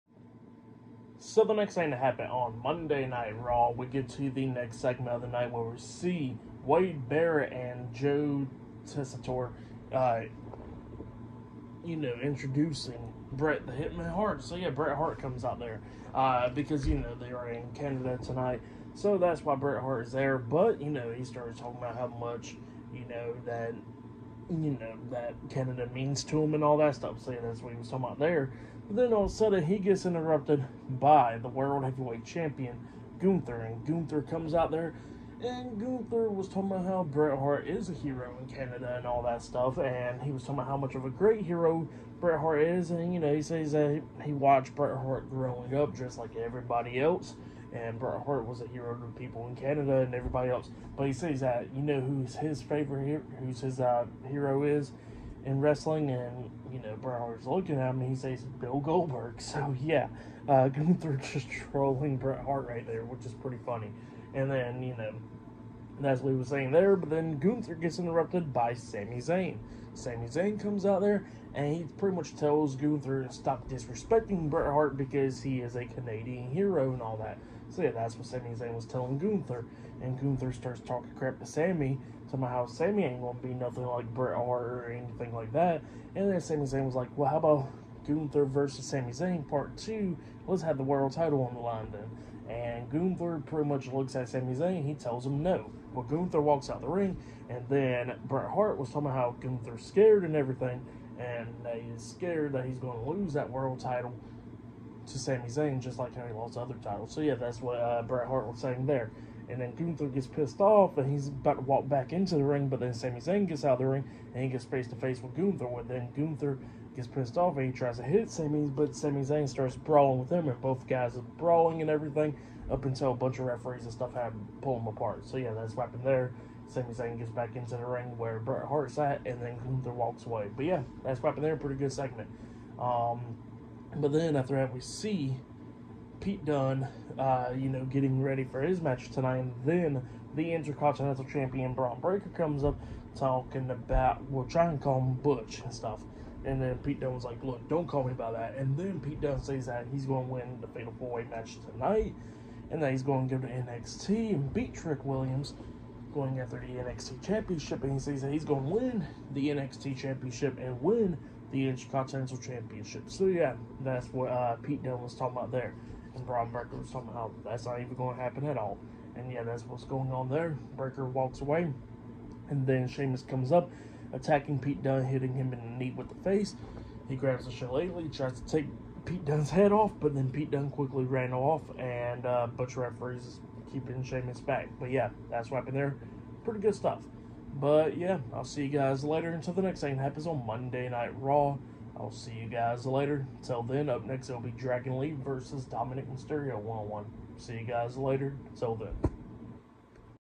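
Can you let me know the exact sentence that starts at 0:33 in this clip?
And Gunther comes out there, and Gunther was talking about how Bret Hart is a hero in Canada and all that stuff.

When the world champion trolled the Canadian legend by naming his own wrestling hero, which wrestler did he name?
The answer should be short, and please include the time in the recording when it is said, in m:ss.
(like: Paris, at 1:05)
Bill Goldberg, at 0:58.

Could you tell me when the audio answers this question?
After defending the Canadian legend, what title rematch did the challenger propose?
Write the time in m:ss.
1:28.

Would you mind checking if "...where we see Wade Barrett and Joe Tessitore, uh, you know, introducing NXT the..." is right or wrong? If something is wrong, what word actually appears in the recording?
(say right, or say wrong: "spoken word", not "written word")
wrong: "Bret", not "NXT".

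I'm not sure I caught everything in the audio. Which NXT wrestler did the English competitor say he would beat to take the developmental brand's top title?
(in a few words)
Trick Williams.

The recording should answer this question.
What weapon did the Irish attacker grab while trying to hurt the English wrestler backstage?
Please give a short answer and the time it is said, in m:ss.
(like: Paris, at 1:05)
Shillelagh, at 2:57.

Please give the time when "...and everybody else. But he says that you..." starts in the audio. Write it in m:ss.
0:49.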